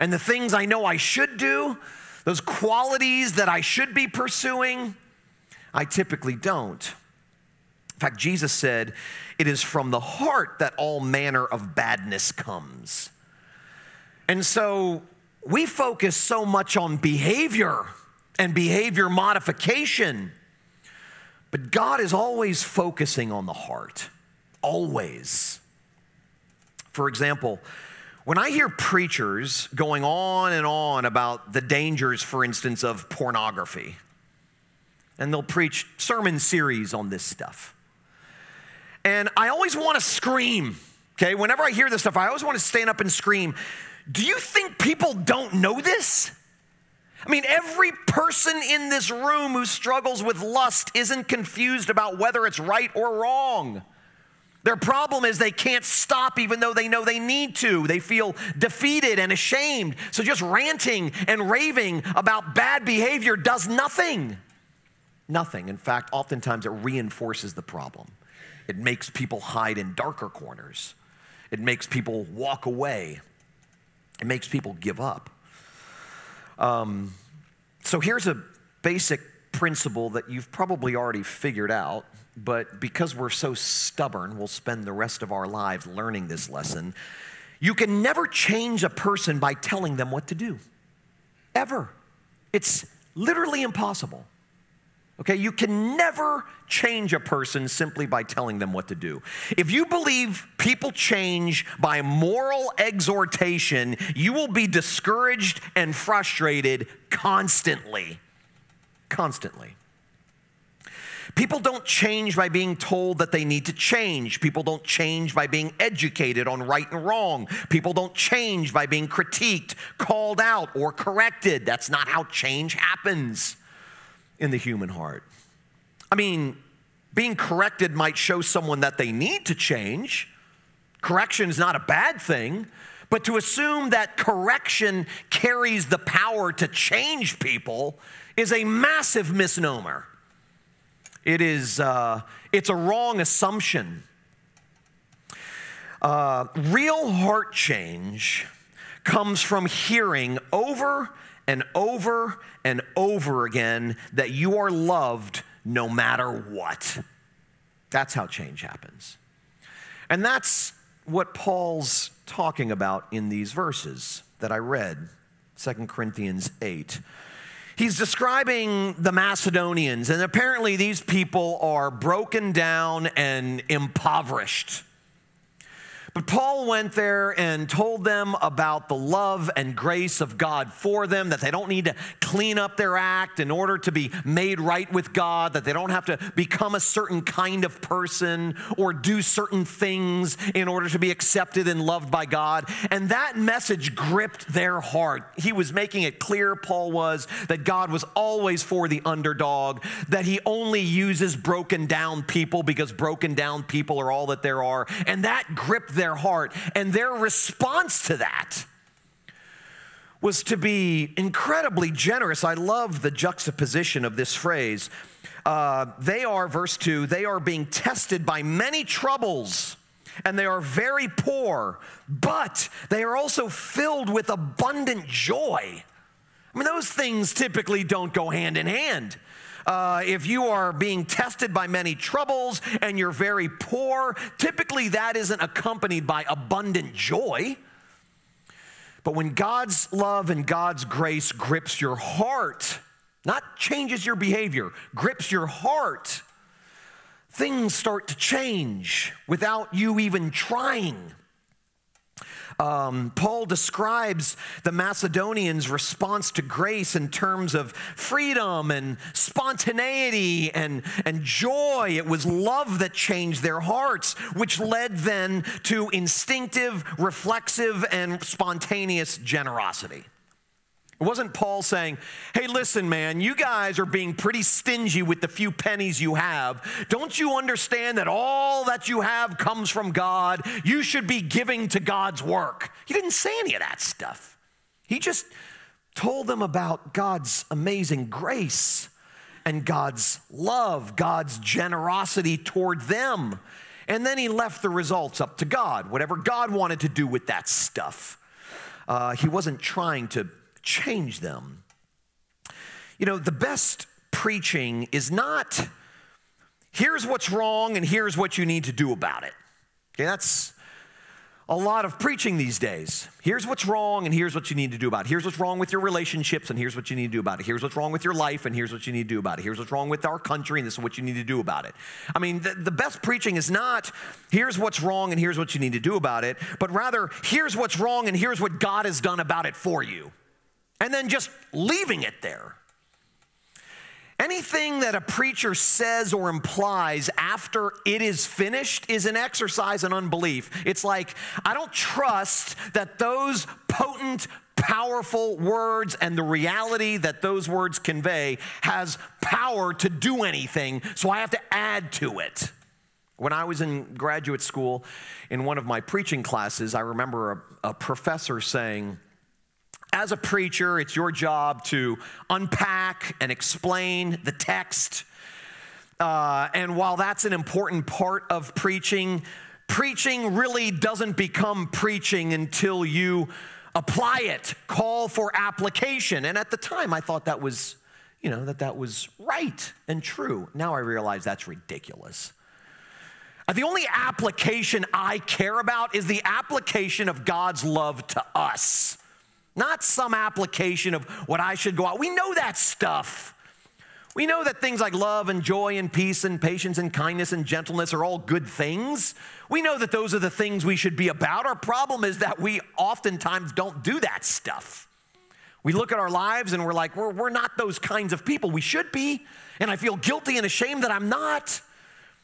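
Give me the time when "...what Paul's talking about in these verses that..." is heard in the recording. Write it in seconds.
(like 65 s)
161 s.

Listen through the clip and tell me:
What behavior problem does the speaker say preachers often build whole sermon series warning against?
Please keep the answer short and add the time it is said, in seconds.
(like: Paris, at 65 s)
pornography, at 33 s.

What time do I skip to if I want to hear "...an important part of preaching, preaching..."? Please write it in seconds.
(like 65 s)
367 s.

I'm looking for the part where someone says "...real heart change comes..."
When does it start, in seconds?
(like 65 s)
146 s.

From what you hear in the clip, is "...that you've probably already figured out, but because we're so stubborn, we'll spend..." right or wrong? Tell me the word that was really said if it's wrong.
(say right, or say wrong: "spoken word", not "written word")
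right.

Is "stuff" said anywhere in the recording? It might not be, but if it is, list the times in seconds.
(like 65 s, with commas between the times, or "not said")
37 s, 42 s, 283 s, 297 s, 392 s, 404 s.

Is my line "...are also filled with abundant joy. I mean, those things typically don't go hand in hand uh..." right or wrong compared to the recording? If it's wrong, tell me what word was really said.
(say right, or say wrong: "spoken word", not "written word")
right.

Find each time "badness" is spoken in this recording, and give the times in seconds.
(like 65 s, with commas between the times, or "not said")
11 s.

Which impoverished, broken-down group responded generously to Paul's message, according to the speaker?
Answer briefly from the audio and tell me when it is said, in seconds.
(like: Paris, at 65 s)
Macedonians, at 169 s.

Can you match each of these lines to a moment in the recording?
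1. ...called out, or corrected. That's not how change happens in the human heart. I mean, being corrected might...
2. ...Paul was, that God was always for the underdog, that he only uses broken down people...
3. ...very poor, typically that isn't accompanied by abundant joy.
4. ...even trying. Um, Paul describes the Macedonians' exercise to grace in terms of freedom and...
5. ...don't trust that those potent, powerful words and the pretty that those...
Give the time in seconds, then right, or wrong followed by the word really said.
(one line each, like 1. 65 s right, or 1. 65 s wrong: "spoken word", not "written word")
1. 119 s right
2. 196 s right
3. 233 s right
4. 249 s wrong: "response", not "exercise"
5. 341 s wrong: "reality", not "pretty".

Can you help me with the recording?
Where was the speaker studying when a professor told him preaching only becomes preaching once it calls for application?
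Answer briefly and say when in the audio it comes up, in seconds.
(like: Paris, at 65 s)
graduate school, at 353 s.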